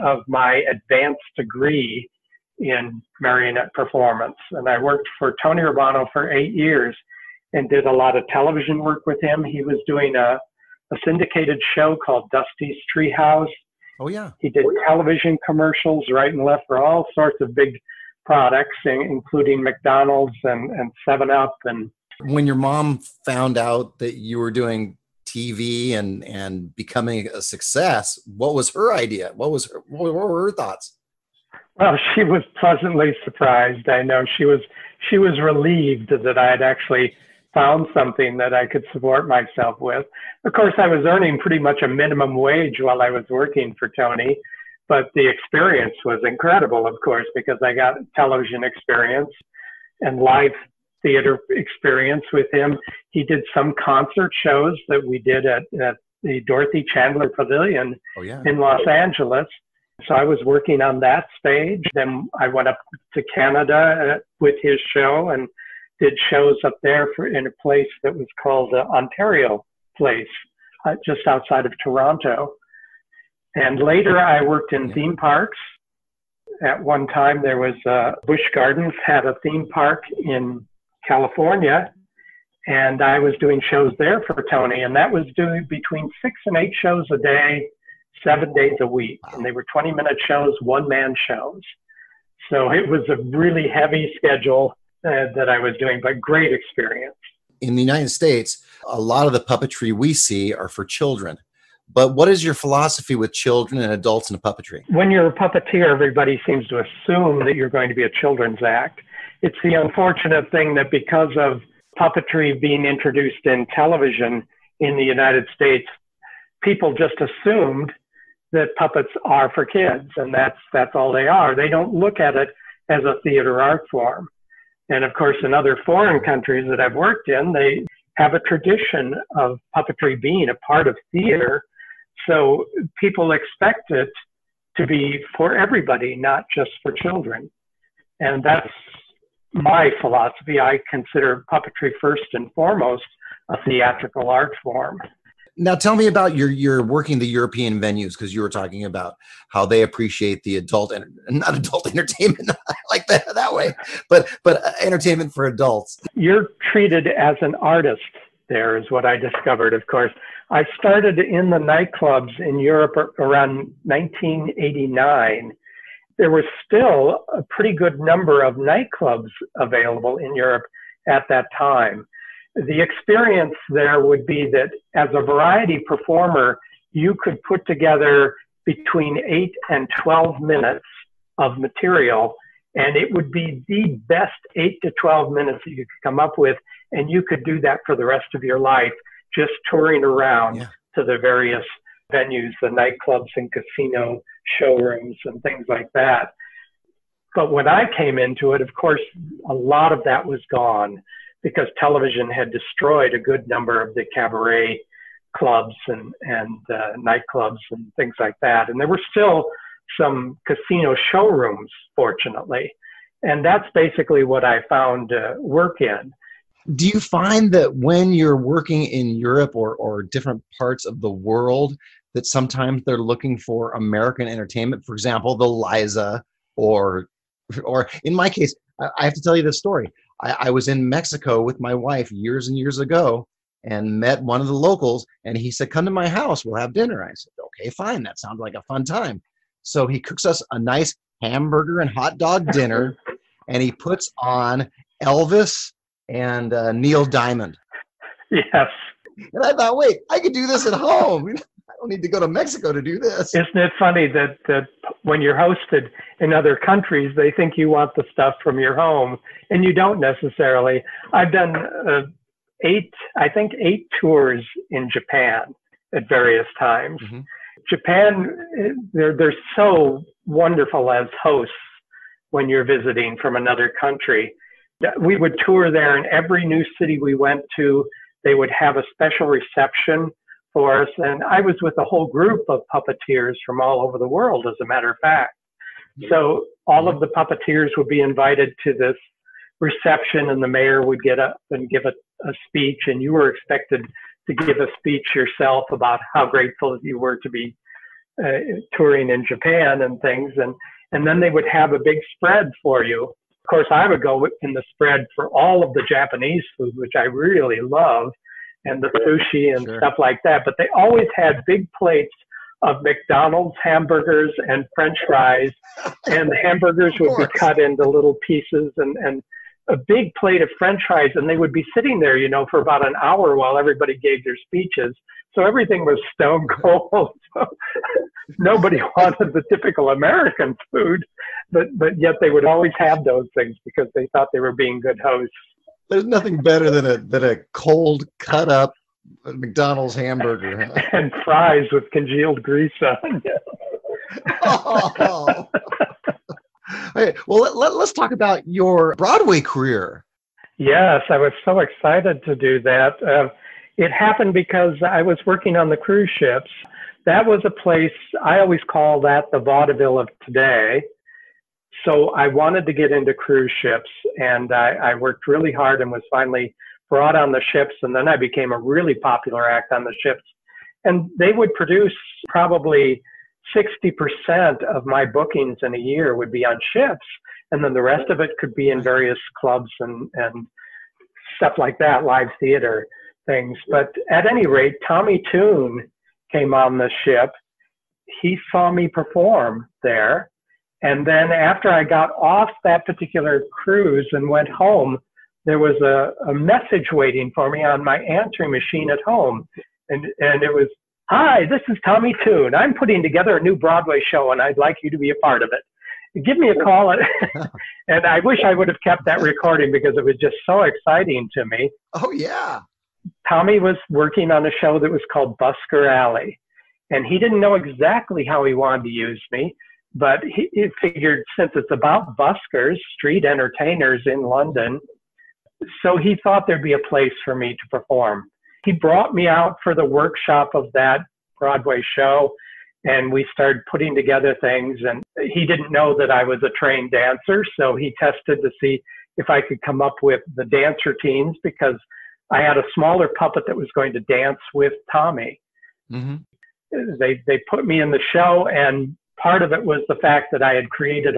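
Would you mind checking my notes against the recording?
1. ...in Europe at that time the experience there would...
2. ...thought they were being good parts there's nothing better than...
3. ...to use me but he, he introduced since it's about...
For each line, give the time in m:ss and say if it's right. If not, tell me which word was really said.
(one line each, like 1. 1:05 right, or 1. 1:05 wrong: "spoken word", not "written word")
1. 2:50 right
2. 5:34 wrong: "hosts", not "parts"
3. 6:58 wrong: "figured", not "introduced".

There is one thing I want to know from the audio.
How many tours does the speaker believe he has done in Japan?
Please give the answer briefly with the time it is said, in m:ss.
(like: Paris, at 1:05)
8, at 4:23.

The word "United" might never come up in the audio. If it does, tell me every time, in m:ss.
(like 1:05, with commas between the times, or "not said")
1:37, 1:55.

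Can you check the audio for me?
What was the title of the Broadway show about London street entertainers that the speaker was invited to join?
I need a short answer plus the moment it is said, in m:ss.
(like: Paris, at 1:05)
Busker Alley, at 6:55.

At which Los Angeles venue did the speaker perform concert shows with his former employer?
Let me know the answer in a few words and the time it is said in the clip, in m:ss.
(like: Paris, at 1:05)
Dorothy Chandler Pavilion, at 0:56.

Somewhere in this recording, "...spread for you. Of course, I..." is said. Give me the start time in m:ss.
5:02.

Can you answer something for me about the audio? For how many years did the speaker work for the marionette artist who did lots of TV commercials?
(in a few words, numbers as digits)
8.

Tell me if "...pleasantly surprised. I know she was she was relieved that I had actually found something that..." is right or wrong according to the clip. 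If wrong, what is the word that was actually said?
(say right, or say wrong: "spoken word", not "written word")
right.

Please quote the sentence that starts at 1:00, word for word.
So I was working on that stage.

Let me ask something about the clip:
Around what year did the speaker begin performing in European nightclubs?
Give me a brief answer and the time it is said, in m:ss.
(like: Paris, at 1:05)
1989, at 2:43.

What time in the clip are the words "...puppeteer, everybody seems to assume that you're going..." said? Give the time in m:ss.
1:45.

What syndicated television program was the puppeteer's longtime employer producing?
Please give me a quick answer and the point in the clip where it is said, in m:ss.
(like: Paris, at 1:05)
Dusty's Treehouse, at 0:12.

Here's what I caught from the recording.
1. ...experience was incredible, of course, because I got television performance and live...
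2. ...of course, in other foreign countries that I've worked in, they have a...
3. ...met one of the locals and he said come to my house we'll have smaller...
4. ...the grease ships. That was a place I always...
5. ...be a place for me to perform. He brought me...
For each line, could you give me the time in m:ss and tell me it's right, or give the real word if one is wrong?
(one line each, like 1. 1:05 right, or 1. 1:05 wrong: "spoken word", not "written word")
1. 0:45 wrong: "experience", not "performance"
2. 2:05 right
3. 3:53 wrong: "dinner", not "smaller"
4. 5:55 wrong: "cruise", not "grease"
5. 7:06 right.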